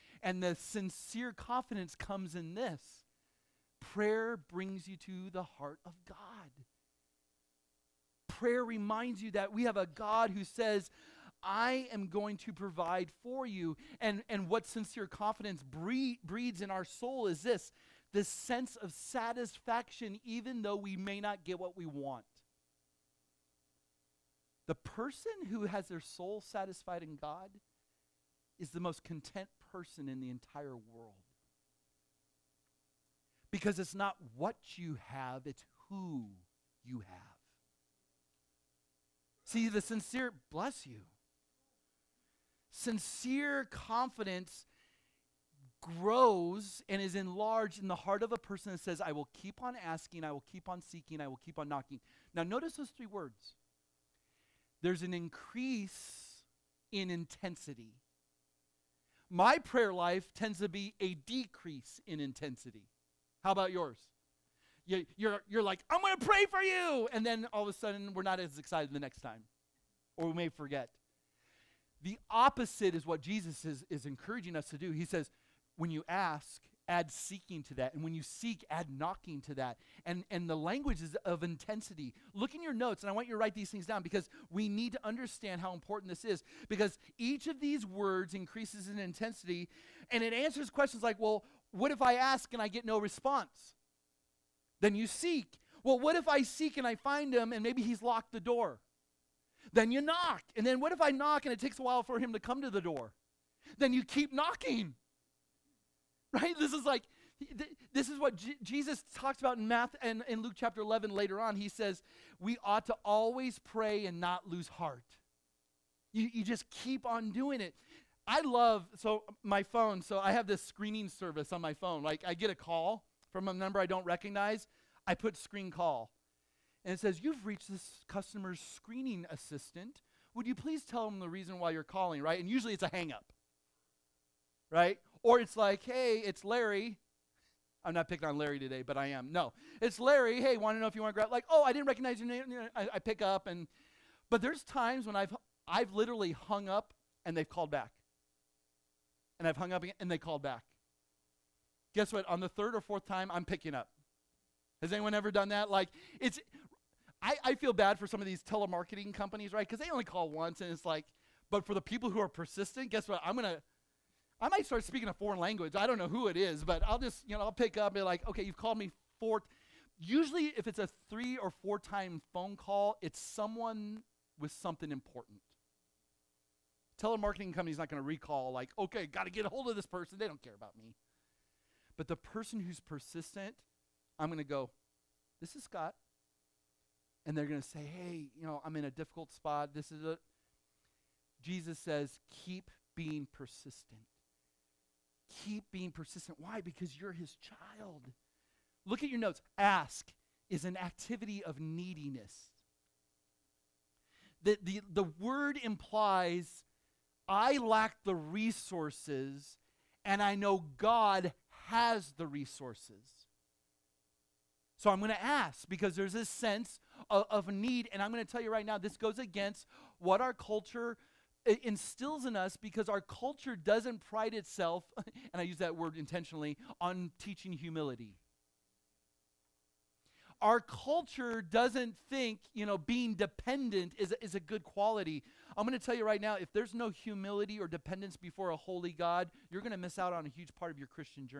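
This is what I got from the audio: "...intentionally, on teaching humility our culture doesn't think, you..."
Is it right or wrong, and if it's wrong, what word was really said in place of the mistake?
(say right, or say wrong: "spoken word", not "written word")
right.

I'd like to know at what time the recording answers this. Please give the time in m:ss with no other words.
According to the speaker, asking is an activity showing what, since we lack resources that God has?
3:21.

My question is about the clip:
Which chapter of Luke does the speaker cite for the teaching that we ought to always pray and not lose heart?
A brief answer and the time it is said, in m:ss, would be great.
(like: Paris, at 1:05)
Luke 11, at 1:50.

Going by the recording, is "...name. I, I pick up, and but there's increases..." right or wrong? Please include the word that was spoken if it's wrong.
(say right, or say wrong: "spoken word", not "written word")
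wrong: "times", not "increases".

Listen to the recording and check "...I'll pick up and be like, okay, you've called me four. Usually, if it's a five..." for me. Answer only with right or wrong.
wrong.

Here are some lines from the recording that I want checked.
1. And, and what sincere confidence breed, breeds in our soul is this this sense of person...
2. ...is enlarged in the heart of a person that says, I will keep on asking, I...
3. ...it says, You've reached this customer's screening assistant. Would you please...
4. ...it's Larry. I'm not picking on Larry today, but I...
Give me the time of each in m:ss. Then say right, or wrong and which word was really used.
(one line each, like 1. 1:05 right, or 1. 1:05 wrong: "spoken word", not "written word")
1. 0:13 wrong: "satisfaction", not "person"
2. 0:47 right
3. 2:06 right
4. 2:16 right.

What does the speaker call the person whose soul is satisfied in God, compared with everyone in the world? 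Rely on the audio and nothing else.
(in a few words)
Most content person.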